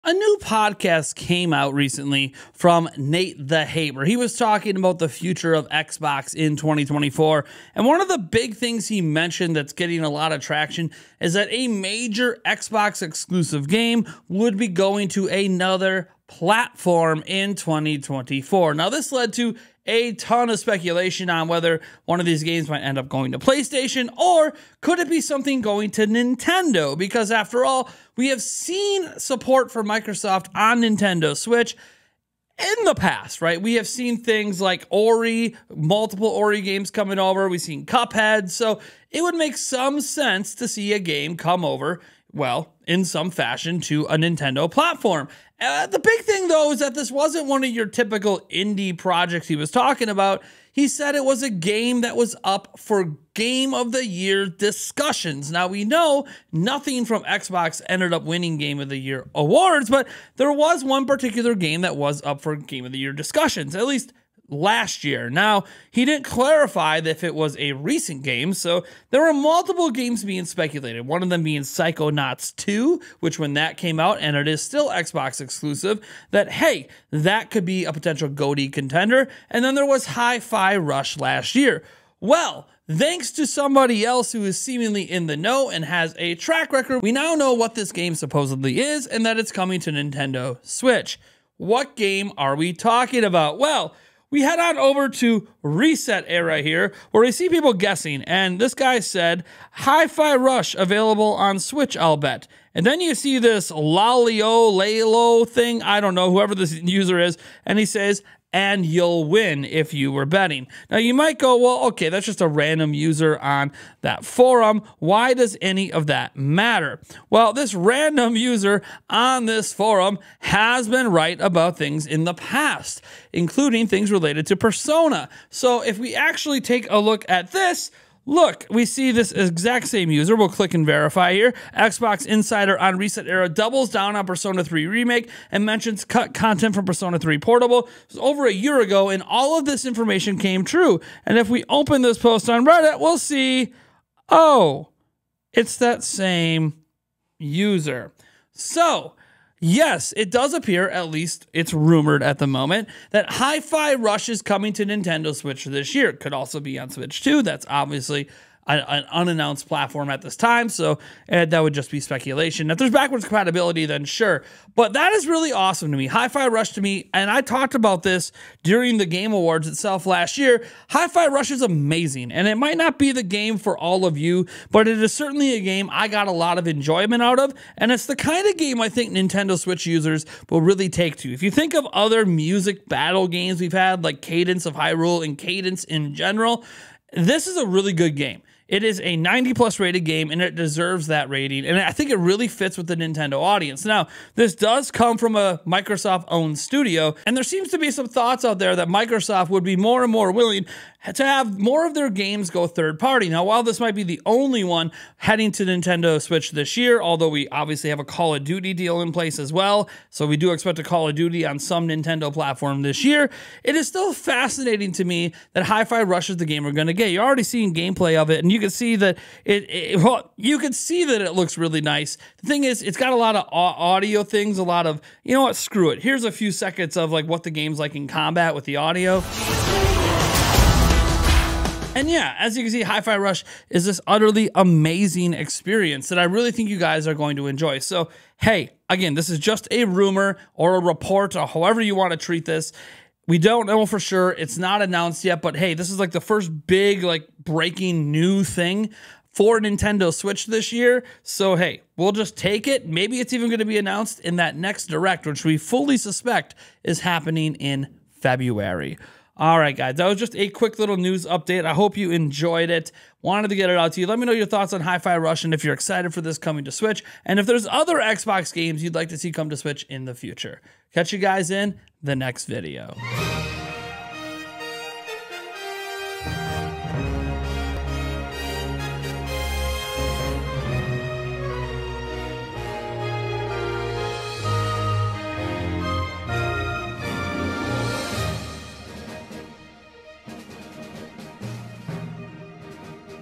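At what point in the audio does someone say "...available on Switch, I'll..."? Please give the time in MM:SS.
01:40.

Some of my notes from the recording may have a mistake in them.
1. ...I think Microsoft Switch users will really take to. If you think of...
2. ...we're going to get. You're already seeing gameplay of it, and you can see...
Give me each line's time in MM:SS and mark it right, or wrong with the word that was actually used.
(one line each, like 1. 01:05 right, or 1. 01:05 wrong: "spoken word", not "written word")
1. 02:58 wrong: "Nintendo", not "Microsoft"
2. 03:36 right.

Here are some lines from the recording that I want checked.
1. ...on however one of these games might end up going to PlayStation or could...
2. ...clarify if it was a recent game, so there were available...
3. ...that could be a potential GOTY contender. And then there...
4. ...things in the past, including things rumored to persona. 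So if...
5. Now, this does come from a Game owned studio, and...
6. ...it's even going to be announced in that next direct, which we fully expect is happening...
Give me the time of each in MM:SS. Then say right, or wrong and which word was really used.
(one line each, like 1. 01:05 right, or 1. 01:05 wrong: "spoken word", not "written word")
1. 00:21 wrong: "whether", not "however"
2. 01:06 wrong: "multiple", not "available"
3. 01:17 right
4. 02:01 wrong: "related", not "rumored"
5. 03:13 wrong: "Microsoft", not "Game"
6. 04:13 wrong: "suspect", not "expect".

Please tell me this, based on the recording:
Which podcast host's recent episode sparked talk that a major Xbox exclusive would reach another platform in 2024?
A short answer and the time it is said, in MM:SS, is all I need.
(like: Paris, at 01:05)
Nate the Hate, at 00:02.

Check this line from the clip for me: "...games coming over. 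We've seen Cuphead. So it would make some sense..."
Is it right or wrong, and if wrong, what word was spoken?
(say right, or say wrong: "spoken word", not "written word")
right.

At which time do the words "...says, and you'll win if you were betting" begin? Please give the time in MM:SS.
01:47.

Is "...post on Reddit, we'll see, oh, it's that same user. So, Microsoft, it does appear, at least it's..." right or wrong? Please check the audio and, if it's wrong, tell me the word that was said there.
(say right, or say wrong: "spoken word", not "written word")
wrong: "Yes", not "Microsoft".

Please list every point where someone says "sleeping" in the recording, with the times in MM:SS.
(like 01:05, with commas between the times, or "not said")
not said.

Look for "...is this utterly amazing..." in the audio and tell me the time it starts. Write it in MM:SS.
03:53.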